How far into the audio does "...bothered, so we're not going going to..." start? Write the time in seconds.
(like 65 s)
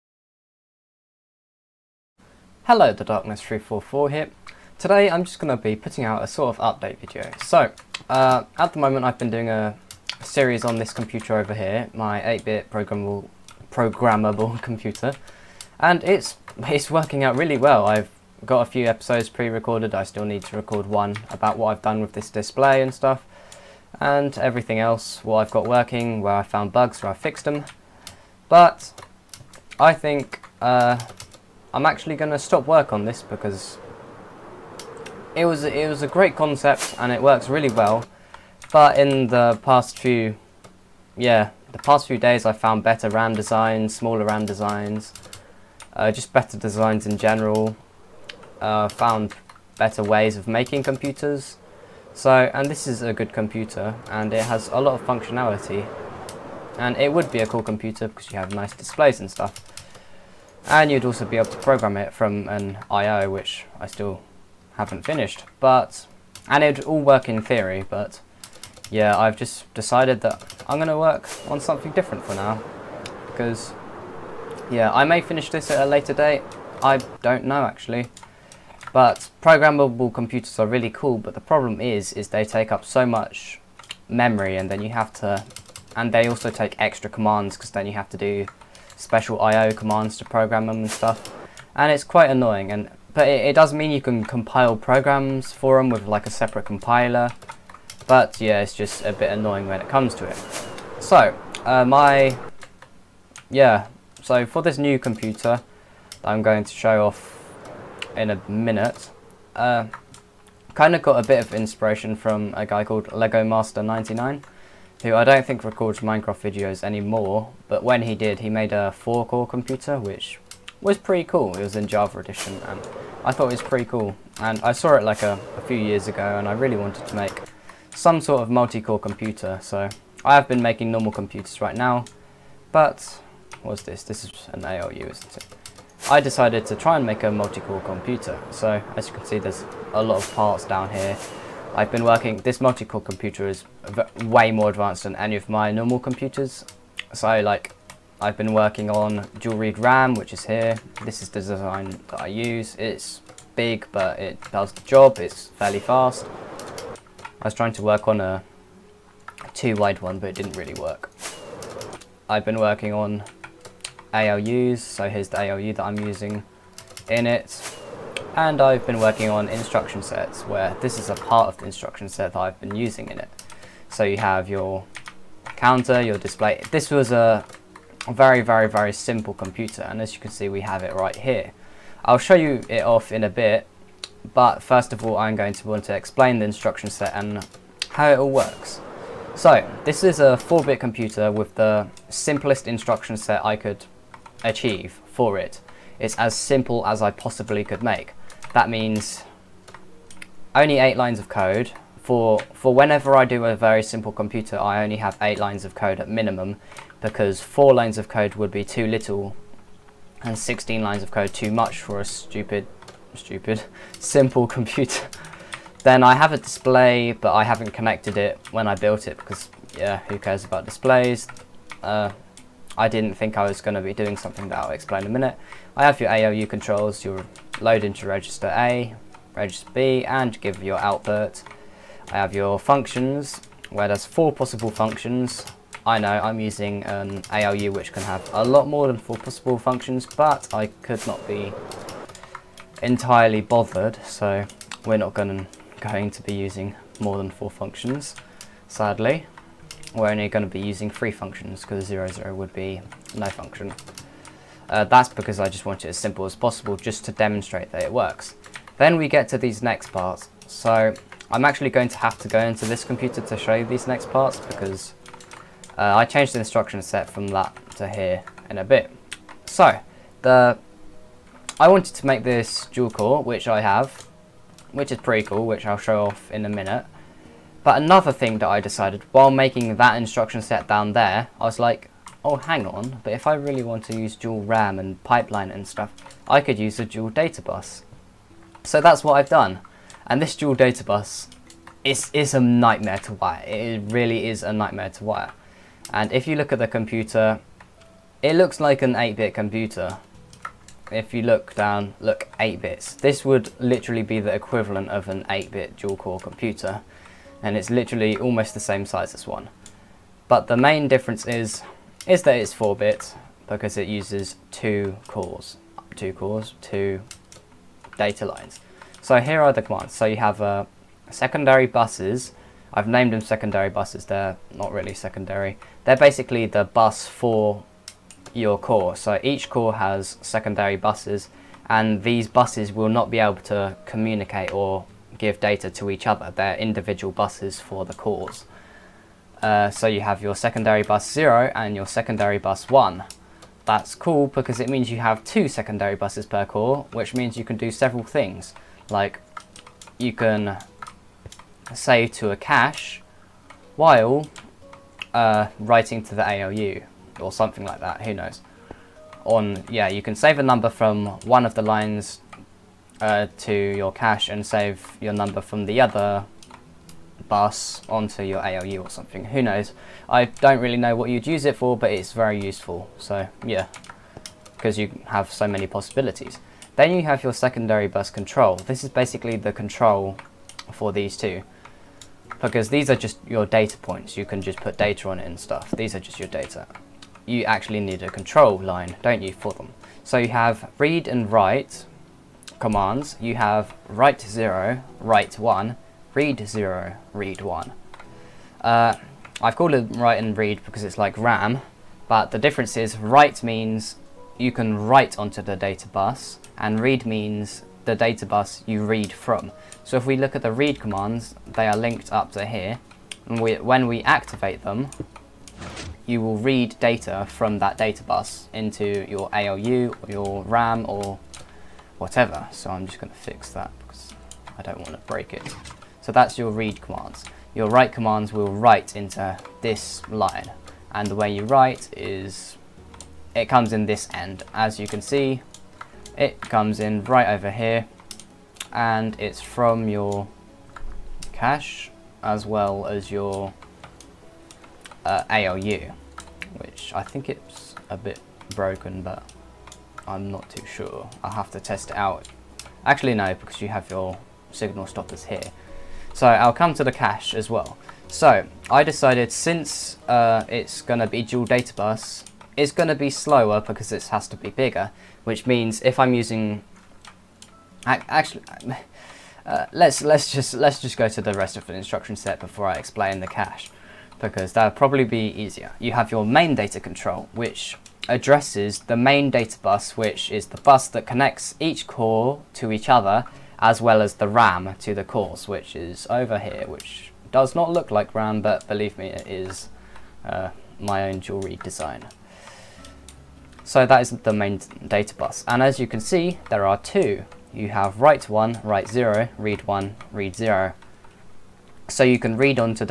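243 s.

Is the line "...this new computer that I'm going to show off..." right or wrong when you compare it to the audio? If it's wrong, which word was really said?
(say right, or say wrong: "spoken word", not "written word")
right.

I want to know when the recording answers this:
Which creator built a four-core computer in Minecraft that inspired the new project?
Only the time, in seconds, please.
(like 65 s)
113 s.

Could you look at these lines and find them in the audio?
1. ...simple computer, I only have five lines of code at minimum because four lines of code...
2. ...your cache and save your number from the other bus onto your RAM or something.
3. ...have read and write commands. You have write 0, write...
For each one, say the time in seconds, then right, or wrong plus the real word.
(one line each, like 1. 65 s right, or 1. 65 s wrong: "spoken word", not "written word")
1. 203 s wrong: "eight", not "five"
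2. 363 s wrong: "ALU", not "RAM"
3. 390 s right.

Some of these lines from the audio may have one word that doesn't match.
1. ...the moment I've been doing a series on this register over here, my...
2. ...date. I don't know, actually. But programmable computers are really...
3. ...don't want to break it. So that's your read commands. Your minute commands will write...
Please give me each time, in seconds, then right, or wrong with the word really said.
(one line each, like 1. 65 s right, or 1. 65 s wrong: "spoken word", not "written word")
1. 8 s wrong: "computer", not "register"
2. 76 s right
3. 424 s wrong: "write", not "minute".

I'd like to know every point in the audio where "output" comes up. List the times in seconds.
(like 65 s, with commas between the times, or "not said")
230 s.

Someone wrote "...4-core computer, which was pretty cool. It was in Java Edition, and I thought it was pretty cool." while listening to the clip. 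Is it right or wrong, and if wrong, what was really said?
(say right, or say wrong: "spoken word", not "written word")
right.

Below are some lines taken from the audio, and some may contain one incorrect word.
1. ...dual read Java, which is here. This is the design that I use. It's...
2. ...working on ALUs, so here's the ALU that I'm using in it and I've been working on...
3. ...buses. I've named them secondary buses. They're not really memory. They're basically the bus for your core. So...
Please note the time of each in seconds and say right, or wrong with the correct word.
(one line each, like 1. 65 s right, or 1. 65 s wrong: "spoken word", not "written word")
1. 149 s wrong: "RAM", not "Java"
2. 162 s right
3. 321 s wrong: "secondary", not "memory".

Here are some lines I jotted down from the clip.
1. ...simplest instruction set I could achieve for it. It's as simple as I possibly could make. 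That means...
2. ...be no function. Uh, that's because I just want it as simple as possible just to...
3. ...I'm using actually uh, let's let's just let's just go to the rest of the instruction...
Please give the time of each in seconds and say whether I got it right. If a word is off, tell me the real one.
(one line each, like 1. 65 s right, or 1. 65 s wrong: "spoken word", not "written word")
1. 192 s right
2. 252 s right
3. 465 s right.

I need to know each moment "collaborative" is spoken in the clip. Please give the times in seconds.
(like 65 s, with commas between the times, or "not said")
not said.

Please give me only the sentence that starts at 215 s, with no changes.
then I have a display, but I haven't connected it when I built it because, yeah, who cares about displays?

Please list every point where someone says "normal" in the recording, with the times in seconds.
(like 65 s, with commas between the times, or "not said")
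130 s, 145 s.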